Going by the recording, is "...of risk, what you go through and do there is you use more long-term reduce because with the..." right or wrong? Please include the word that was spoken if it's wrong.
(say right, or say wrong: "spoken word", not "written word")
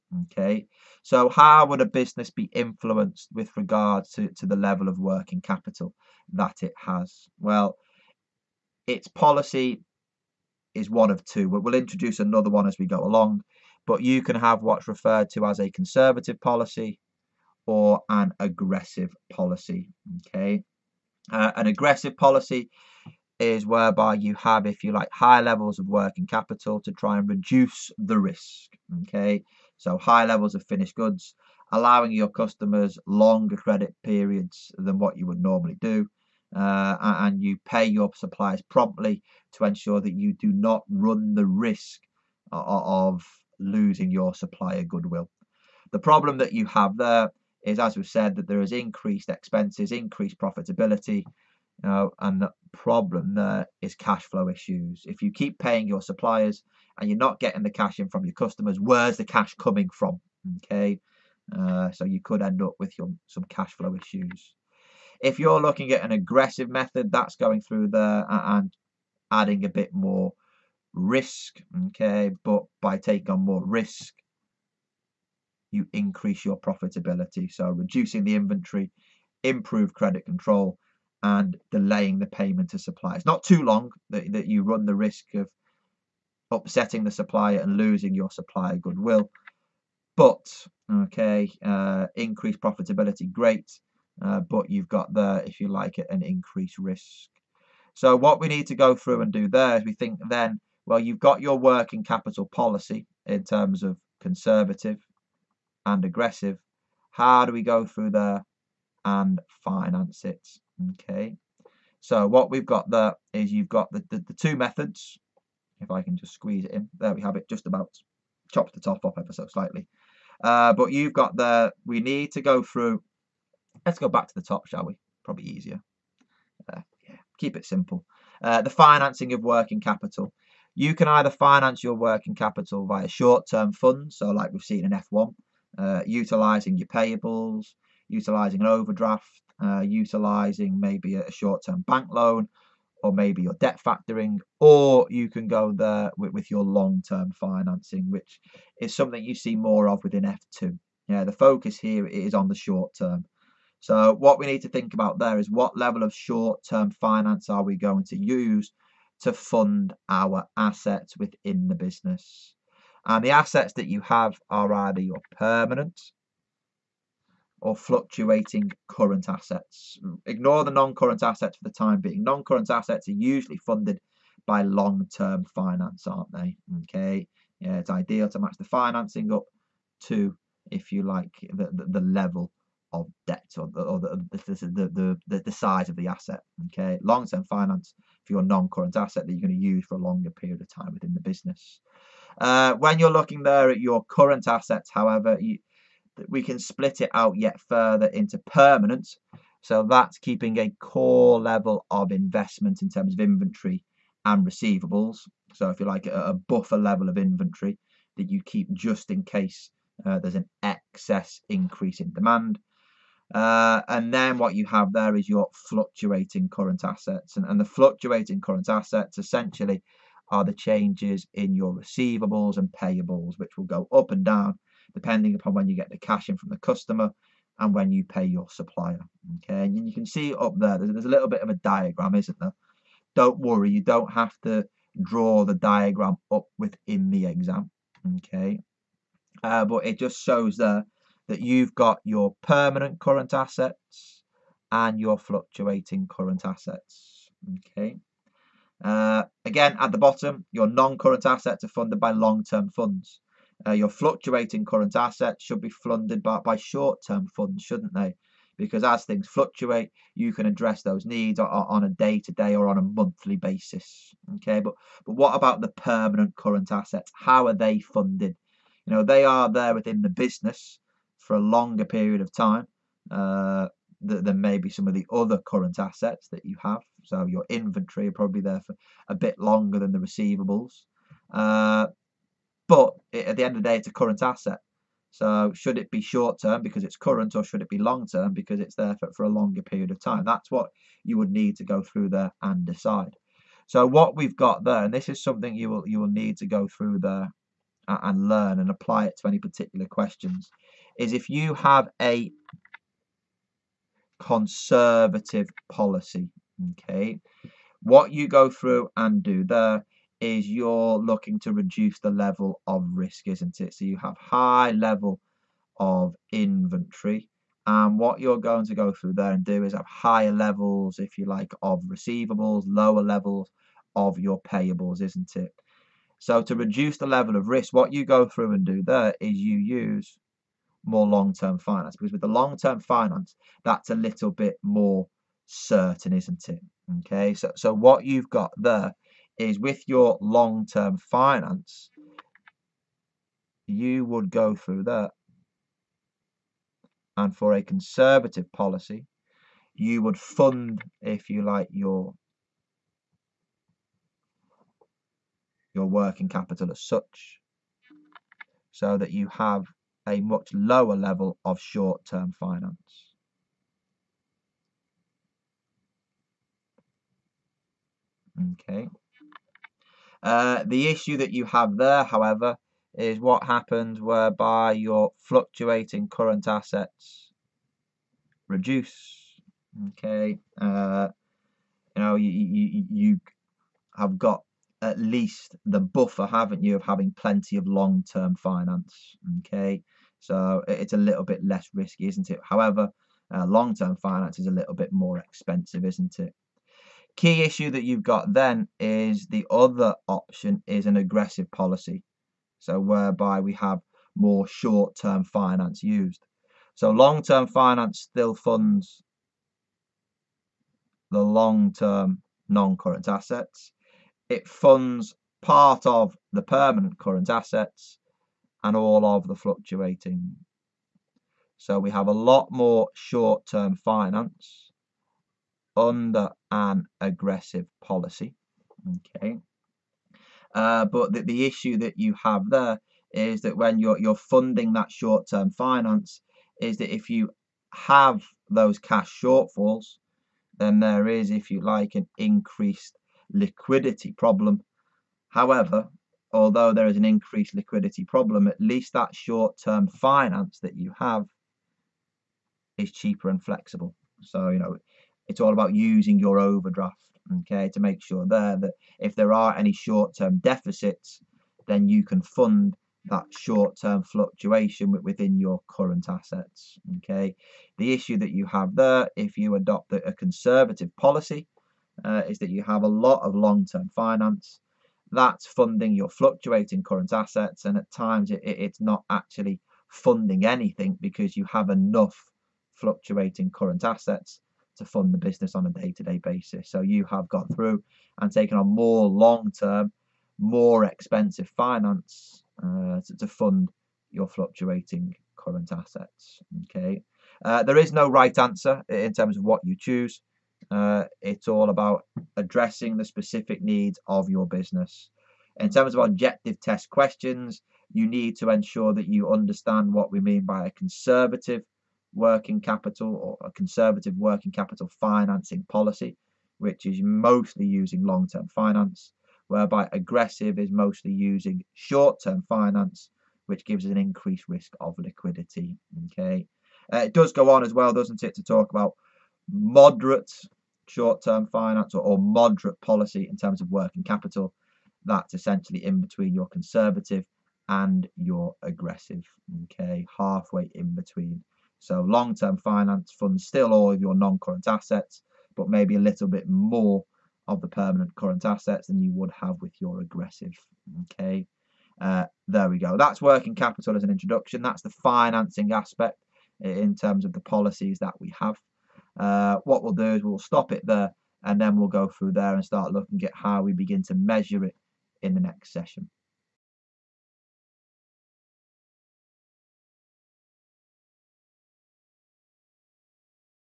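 wrong: "finance", not "reduce".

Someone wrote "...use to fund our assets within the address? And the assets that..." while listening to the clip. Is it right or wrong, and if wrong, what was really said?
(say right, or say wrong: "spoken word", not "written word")
wrong: "business", not "address".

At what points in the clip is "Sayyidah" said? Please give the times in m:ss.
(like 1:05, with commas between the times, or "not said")
not said.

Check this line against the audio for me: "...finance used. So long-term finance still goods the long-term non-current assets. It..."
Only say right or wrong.
wrong.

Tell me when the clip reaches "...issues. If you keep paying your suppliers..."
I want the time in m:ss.
0:54.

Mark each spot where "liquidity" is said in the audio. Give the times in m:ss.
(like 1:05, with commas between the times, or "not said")
7:23, 7:27, 8:44.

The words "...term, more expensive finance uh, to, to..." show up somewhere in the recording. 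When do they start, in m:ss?
8:09.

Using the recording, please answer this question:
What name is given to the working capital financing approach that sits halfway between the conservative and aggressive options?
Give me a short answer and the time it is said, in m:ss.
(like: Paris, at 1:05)
moderate policy, at 8:52.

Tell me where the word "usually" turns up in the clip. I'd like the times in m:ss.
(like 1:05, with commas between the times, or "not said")
2:53.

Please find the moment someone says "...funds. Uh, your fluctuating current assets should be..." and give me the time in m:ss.
4:12.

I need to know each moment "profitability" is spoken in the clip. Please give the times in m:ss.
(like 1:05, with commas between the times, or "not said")
0:50, 1:16, 1:32.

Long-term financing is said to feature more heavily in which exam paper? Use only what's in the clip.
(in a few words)
F2.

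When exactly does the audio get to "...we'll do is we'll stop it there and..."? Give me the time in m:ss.
9:19.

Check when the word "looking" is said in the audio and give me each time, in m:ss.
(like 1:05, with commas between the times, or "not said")
1:05, 3:13, 5:10, 9:22.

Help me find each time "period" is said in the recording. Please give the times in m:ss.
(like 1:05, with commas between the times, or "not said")
0:34, 3:10, 4:31, 4:49.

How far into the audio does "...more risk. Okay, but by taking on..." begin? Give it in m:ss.
1:09.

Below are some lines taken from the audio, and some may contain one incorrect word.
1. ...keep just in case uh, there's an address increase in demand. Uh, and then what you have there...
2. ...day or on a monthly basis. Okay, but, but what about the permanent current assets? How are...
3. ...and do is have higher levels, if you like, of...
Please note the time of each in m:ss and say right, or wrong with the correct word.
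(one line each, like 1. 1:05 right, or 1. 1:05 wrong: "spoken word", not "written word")
1. 3:28 wrong: "excess", not "address"
2. 4:22 right
3. 5:19 right.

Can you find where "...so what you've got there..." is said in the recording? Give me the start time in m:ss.
5:37.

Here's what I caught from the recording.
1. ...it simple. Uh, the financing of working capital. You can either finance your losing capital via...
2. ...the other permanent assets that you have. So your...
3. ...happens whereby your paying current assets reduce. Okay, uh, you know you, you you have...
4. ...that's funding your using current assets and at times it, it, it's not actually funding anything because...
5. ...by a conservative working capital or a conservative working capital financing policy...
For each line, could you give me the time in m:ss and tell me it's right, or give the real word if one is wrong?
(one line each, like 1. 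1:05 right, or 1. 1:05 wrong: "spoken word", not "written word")
1. 2:07 wrong: "working", not "losing"
2. 4:34 wrong: "current", not "permanent"
3. 6:13 wrong: "fluctuating", not "paying"
4. 7:55 wrong: "fluctuating", not "using"
5. 8:30 right.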